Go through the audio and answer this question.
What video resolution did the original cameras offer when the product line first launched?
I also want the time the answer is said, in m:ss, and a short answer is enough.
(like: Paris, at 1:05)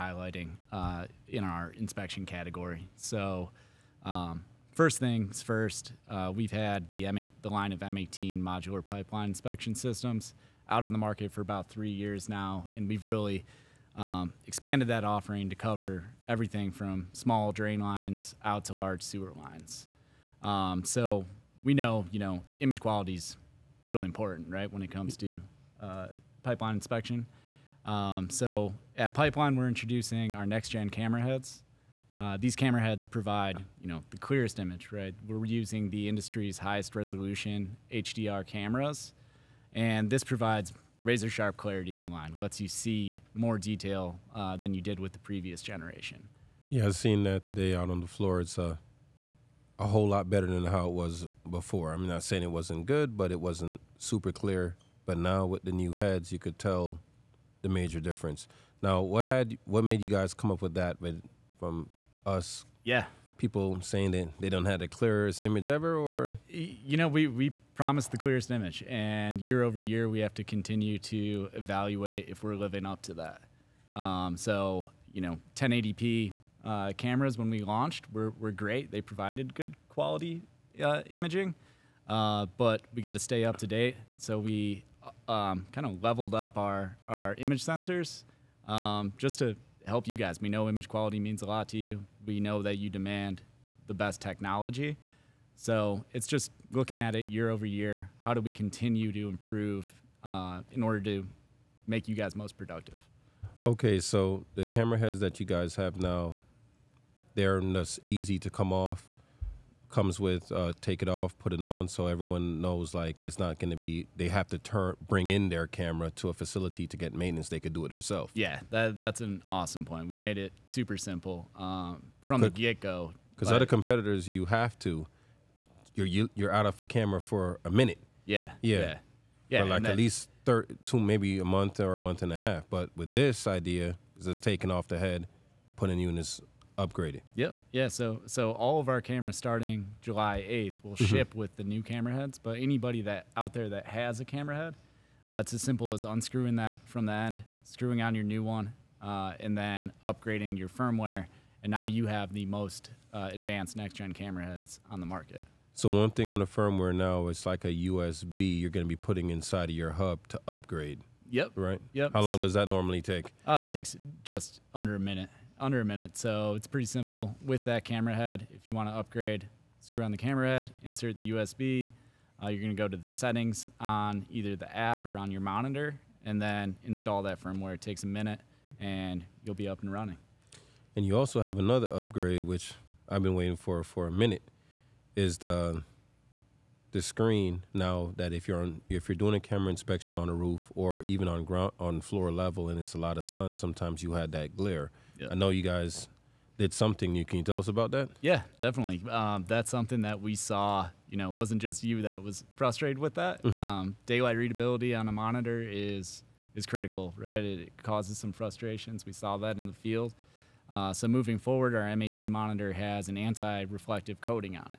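1080p, at 1:15.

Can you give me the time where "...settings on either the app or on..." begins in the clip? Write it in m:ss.
2:53.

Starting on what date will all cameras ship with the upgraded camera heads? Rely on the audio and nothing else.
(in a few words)
July 8th.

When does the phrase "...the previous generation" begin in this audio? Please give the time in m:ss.
0:45.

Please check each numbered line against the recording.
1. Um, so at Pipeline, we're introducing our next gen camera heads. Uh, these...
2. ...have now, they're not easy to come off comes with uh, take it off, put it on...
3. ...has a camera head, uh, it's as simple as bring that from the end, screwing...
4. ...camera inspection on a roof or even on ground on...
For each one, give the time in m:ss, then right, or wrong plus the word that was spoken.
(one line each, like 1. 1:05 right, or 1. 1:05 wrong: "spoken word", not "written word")
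1. 0:27 right
2. 1:45 right
3. 2:23 wrong: "unscrewing", not "bring"
4. 3:09 right.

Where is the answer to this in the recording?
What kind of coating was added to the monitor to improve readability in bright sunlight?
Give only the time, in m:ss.
3:33.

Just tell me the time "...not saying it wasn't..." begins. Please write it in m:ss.
0:52.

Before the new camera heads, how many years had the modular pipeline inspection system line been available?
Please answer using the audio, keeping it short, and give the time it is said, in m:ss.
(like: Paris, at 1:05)
3 years, at 0:11.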